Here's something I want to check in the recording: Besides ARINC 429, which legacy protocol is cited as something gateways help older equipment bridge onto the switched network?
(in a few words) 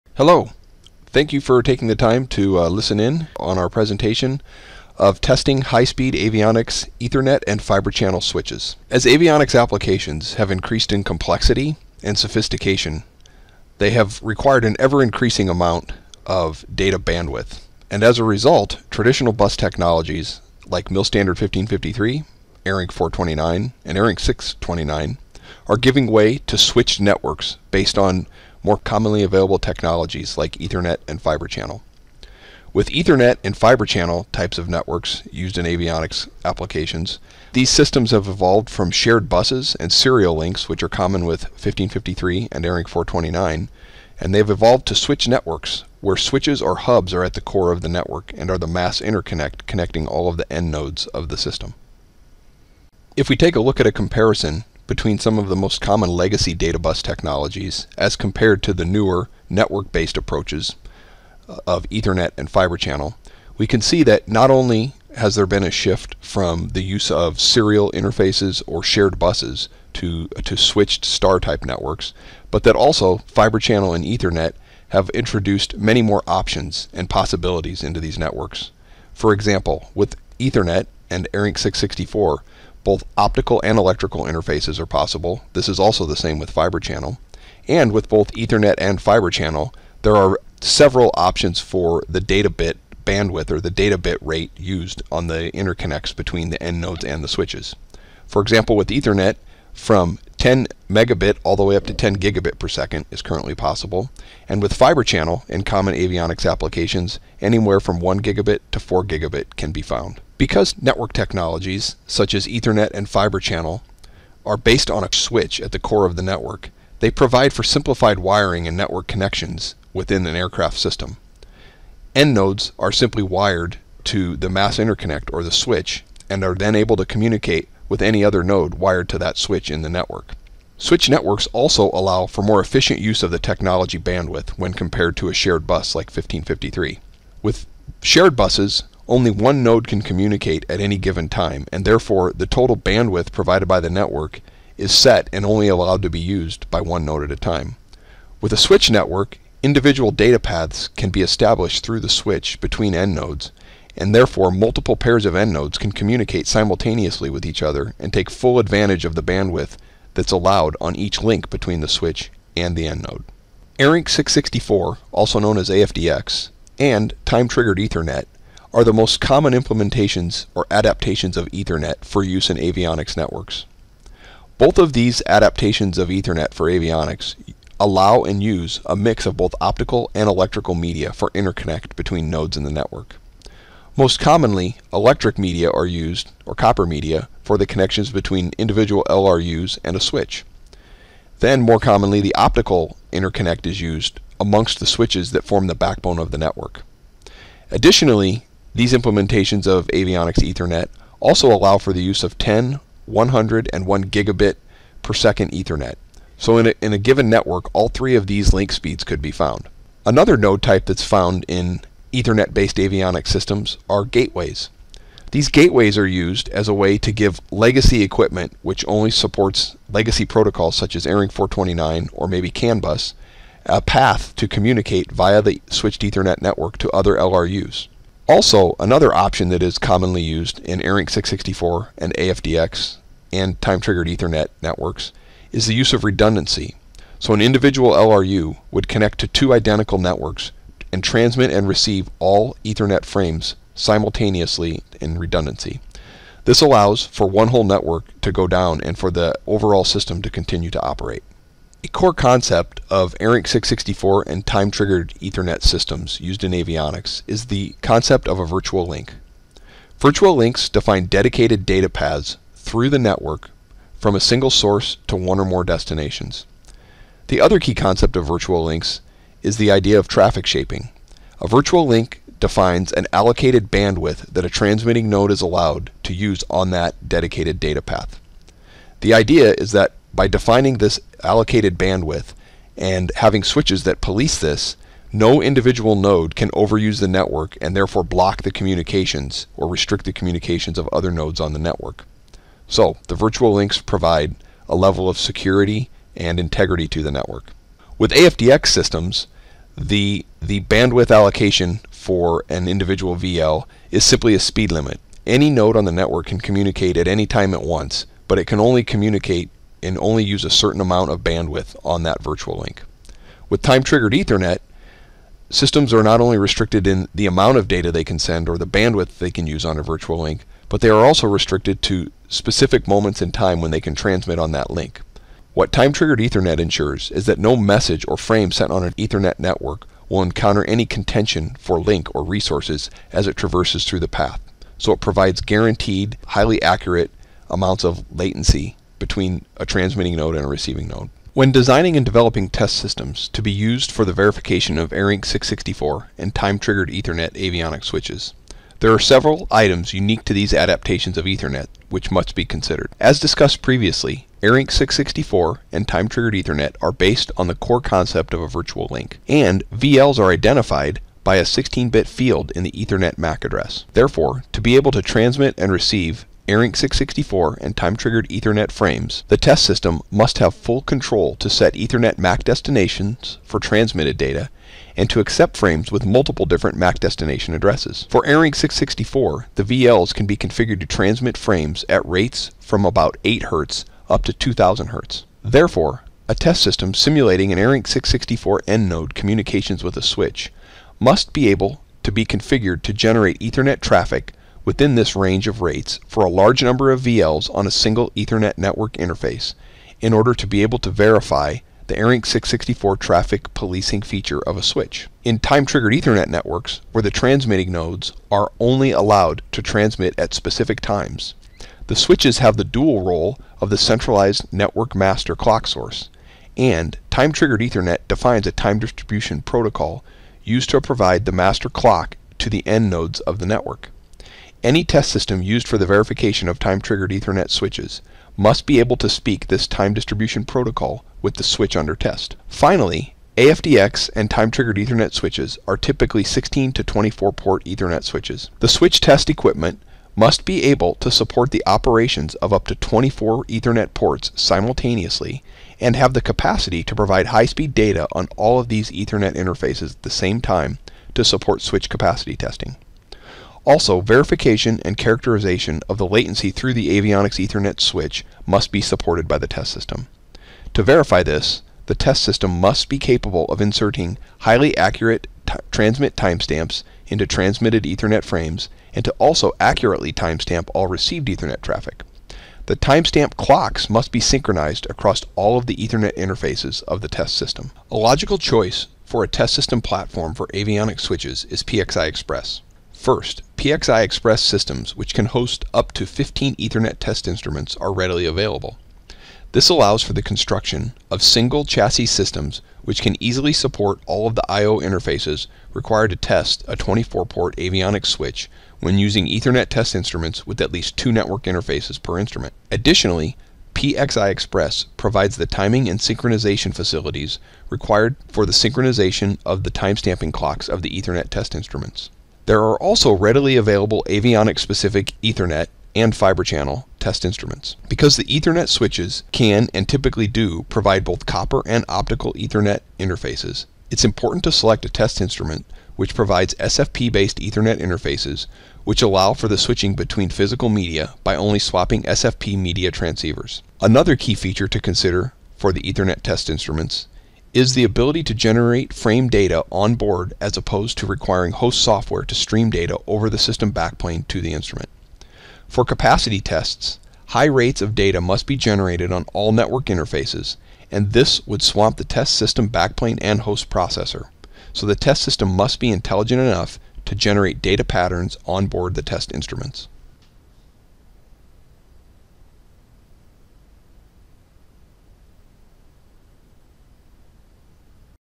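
CAN bus.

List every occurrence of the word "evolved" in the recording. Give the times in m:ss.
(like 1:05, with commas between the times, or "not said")
0:38, 0:44.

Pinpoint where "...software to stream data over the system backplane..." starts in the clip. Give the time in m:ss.
9:01.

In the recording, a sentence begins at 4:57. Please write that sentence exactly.
With AFDX systems, the, the bandwidth allocation for an individual VL is simply a speed limit.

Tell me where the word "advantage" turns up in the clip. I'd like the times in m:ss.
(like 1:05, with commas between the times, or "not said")
2:38.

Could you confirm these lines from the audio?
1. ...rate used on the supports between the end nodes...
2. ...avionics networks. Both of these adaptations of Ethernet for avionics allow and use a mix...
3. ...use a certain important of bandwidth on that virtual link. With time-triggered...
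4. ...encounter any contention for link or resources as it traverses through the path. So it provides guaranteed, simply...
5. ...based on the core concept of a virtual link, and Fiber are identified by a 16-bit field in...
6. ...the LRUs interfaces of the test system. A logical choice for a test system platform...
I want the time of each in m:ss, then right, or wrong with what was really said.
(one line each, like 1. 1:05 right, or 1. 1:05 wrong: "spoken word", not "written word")
1. 1:34 wrong: "interconnects", not "supports"
2. 2:52 right
3. 5:10 wrong: "amount", not "important"
4. 5:30 wrong: "highly", not "simply"
5. 5:56 wrong: "VLs", not "Fiber"
6. 7:55 wrong: "Ethernet", not "LRUs".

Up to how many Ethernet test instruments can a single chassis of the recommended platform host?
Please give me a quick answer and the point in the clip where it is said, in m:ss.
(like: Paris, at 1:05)
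15, at 8:06.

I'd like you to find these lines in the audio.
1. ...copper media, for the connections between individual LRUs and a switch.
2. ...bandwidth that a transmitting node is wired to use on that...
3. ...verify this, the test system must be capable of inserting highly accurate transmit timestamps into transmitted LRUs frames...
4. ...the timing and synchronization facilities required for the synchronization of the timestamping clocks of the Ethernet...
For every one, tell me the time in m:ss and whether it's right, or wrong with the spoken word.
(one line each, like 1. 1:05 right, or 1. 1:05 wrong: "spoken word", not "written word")
1. 3:06 right
2. 4:33 wrong: "allowed", not "wired"
3. 7:40 wrong: "Ethernet", not "LRUs"
4. 8:25 right.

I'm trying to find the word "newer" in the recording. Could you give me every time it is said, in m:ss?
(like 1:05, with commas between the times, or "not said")
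0:58.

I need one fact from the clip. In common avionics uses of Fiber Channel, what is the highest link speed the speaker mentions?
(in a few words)
4 gigabit.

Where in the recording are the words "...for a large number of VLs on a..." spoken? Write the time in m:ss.
6:36.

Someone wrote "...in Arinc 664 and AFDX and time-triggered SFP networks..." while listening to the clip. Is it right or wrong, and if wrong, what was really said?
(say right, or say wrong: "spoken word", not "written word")
wrong: "Ethernet", not "SFP".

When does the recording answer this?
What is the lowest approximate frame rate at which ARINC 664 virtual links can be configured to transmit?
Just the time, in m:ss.
6:23.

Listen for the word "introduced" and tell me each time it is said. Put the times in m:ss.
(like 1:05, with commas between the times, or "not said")
1:15.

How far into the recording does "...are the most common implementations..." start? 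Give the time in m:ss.
2:48.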